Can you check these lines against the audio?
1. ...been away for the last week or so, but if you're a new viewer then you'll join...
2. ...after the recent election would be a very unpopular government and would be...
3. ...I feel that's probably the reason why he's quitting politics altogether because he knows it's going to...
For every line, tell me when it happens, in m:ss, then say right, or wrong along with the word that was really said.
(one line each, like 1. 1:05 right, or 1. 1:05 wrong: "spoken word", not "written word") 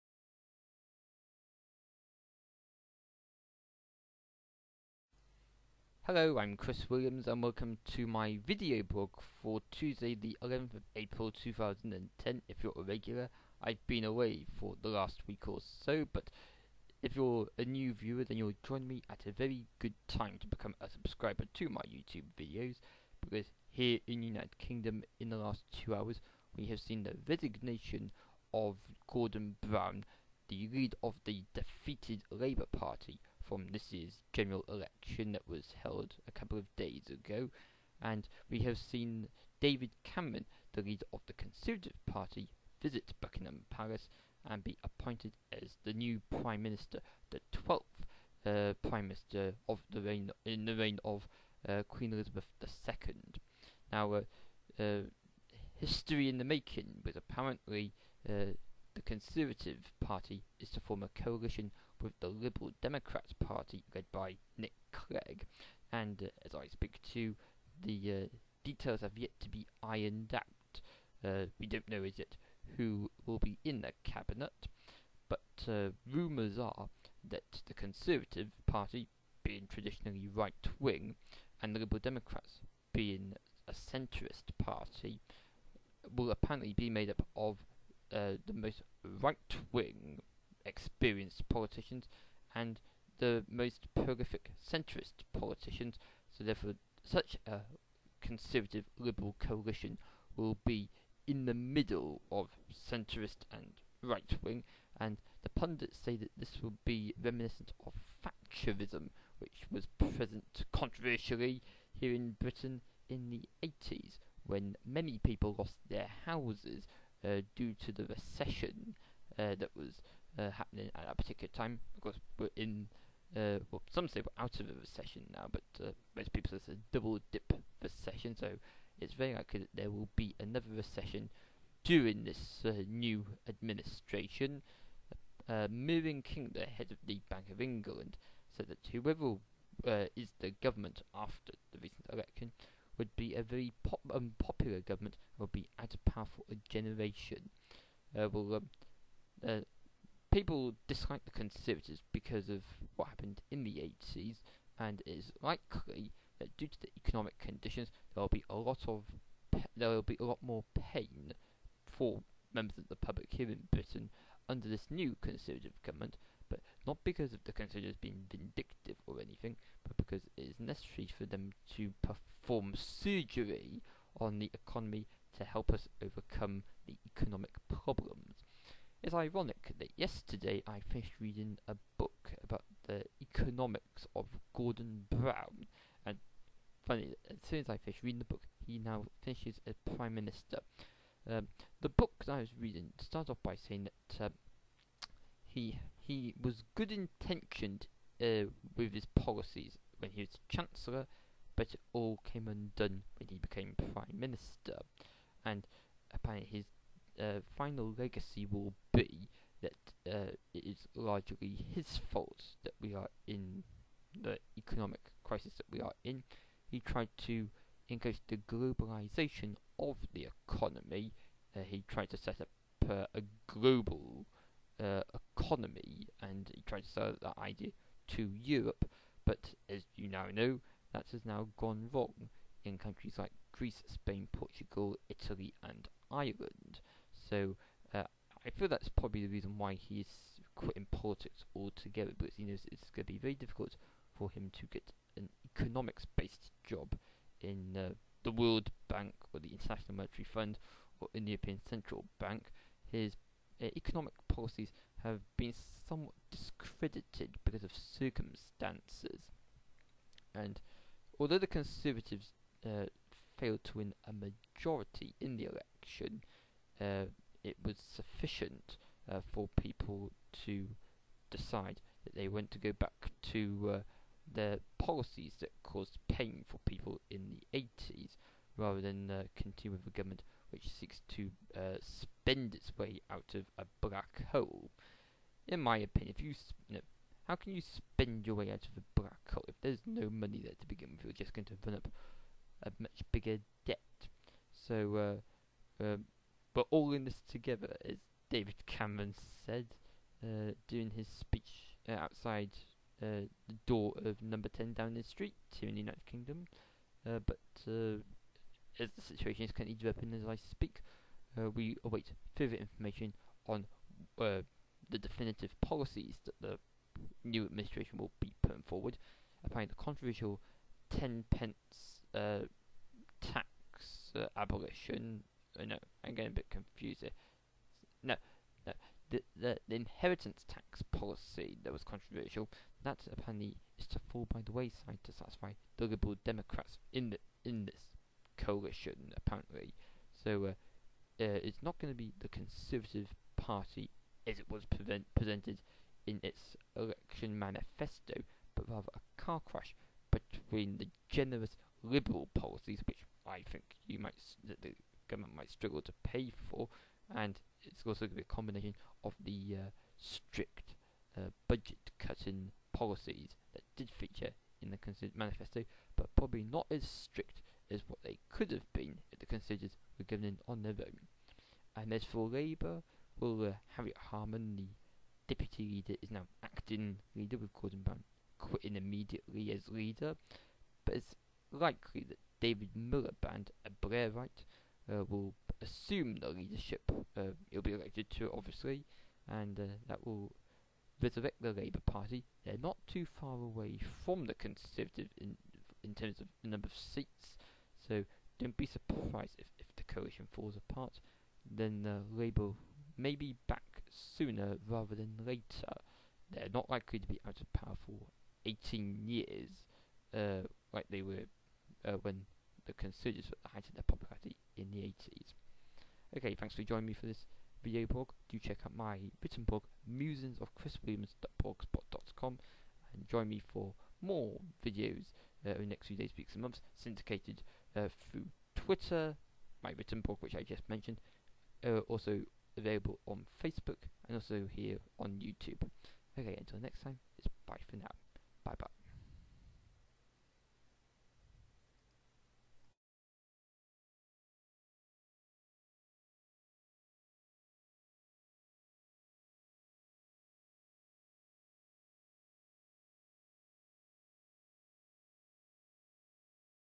1. 0:13 right
2. 2:21 right
3. 3:58 right.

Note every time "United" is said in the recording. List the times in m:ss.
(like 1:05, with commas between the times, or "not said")
0:24, 5:05.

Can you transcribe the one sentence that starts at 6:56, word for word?
Okay, thanks for joining me for this video blog.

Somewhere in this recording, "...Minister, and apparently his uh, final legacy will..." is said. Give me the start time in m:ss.
3:24.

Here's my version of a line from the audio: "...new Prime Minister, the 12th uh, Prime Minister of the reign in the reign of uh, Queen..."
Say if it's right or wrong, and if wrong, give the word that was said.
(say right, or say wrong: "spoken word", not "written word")
right.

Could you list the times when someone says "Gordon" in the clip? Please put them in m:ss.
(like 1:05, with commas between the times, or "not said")
0:29, 3:04, 6:17.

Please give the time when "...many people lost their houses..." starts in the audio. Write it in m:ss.
1:54.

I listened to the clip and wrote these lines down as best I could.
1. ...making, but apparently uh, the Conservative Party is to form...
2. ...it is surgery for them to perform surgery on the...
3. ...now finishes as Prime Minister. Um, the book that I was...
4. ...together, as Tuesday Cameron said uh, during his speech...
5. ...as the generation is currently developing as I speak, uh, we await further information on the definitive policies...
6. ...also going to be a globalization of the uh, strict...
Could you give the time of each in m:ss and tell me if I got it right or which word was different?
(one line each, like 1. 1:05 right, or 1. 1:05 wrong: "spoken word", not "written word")
1. 0:56 right
2. 2:50 wrong: "necessary", not "surgery"
3. 3:08 right
4. 4:57 wrong: "David", not "Tuesday"
5. 5:08 wrong: "situation", not "generation"
6. 5:57 wrong: "combination", not "globalization".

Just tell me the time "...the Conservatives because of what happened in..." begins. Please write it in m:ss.
2:31.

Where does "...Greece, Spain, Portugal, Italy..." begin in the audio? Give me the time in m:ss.
3:53.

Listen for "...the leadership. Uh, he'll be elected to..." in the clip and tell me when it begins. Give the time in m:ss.
6:26.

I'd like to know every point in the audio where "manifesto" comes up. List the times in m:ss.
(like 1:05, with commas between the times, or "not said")
5:47, 6:05.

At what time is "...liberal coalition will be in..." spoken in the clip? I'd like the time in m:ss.
1:38.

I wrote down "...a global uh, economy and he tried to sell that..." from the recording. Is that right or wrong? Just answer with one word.
right.